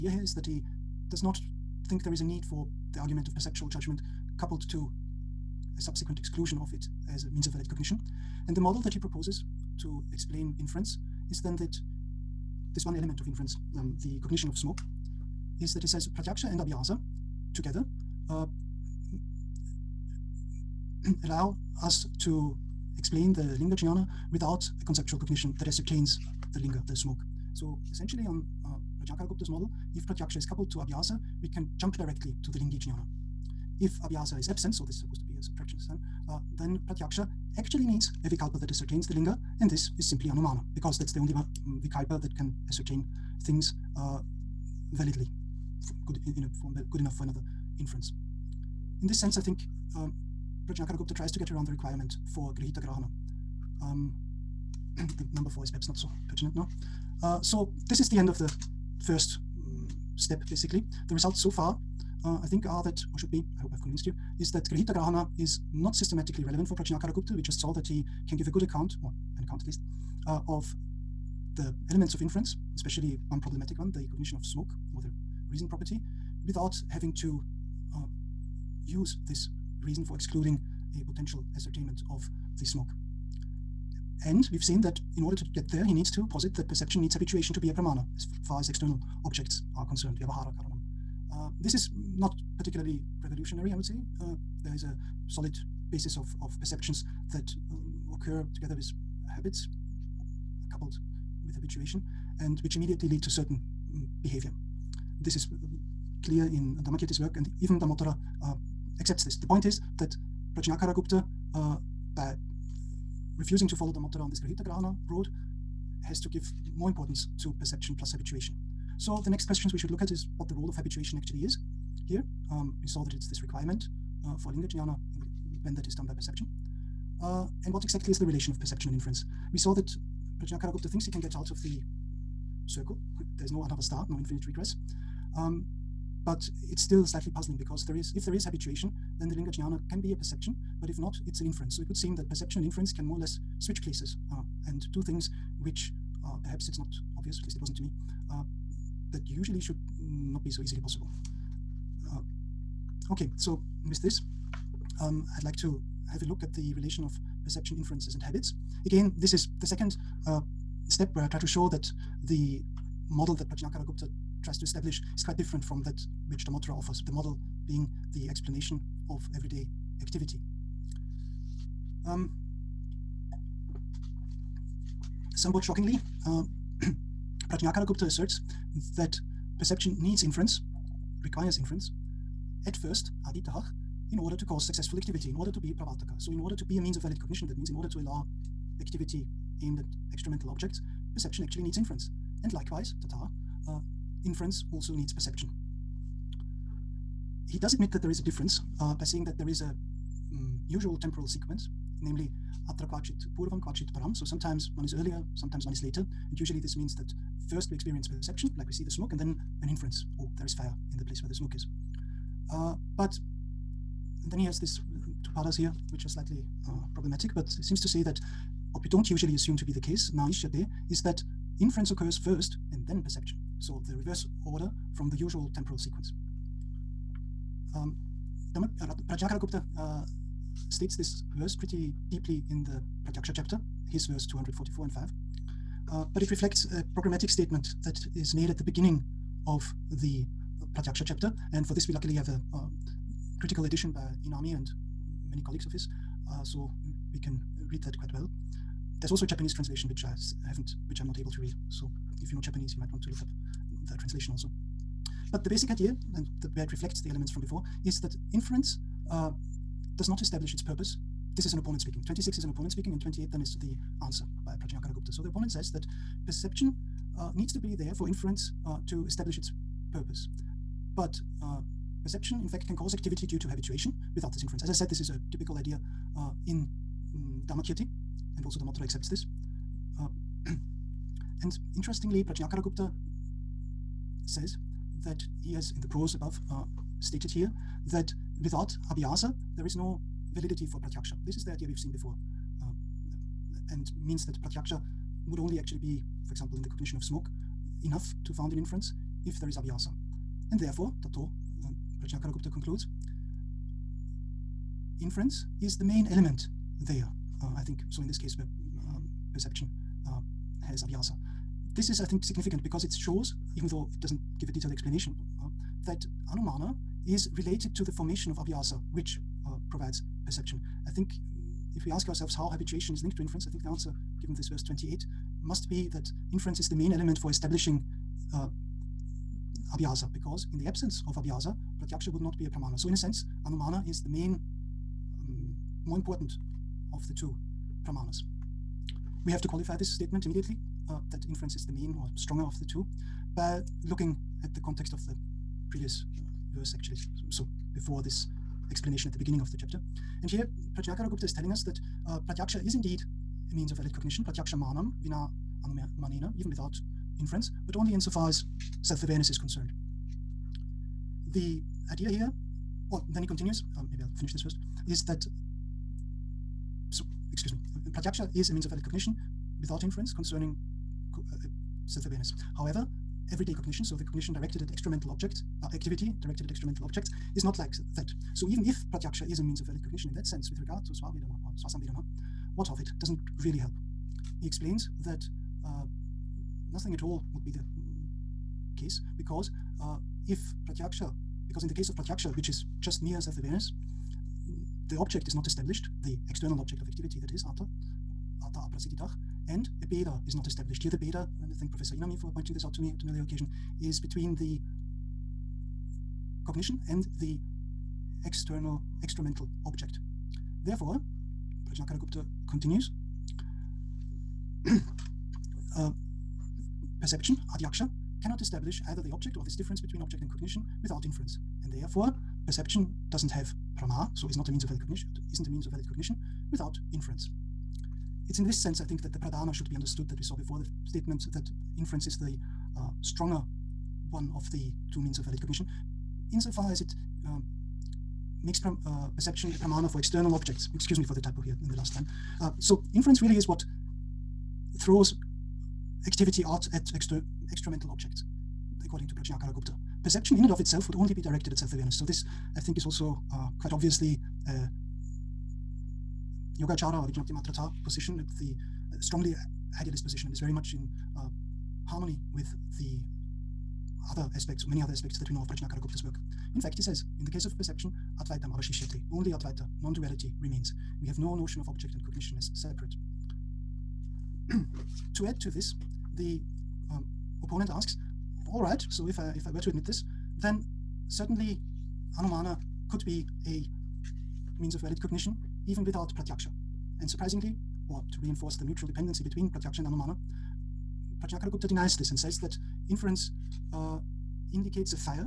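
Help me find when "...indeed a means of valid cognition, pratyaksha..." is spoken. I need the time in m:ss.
5:52.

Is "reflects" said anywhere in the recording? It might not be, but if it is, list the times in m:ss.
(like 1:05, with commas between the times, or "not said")
3:56, 4:16.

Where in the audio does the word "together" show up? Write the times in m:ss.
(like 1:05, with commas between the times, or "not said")
0:17, 1:38.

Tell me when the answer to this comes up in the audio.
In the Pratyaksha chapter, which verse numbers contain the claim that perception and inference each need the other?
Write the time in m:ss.
3:54.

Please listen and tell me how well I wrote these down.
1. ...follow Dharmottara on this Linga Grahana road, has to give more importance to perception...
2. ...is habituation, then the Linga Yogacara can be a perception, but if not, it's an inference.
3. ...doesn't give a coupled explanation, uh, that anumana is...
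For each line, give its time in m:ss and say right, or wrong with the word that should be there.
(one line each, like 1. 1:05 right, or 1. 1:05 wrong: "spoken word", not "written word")
1. 1:53 wrong: "Grihita", not "Linga"
2. 2:18 wrong: "Jnana", not "Yogacara"
3. 5:14 wrong: "detailed", not "coupled".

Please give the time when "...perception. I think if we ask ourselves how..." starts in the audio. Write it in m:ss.
5:20.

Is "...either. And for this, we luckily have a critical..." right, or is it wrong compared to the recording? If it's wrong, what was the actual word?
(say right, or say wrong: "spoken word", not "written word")
wrong: "chapter", not "either".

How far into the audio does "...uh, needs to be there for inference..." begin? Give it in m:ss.
4:27.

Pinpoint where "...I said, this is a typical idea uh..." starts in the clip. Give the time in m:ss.
4:34.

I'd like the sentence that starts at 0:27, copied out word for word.
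So essentially on uh, Prajakaragupta's model, if pratyaksha is coupled to abhyasa, we can jump directly to the lingi jnana.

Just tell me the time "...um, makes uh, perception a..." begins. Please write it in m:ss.
7:17.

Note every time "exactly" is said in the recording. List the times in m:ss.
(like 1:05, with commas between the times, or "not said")
2:07.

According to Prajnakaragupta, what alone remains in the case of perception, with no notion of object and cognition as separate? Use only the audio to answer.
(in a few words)
Advaita.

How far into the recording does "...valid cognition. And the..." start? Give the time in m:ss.
0:07.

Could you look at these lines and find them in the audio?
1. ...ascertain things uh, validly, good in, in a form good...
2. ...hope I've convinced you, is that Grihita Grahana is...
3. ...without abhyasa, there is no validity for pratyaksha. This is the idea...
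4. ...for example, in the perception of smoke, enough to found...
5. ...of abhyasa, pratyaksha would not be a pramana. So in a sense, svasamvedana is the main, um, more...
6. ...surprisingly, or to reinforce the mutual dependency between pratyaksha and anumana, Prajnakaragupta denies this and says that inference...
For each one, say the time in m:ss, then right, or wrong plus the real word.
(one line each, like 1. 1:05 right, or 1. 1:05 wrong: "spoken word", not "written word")
1. 0:42 right
2. 1:03 right
3. 4:48 right
4. 4:56 wrong: "cognition", not "perception"
5. 5:31 wrong: "anumana", not "svasamvedana"
6. 8:07 right.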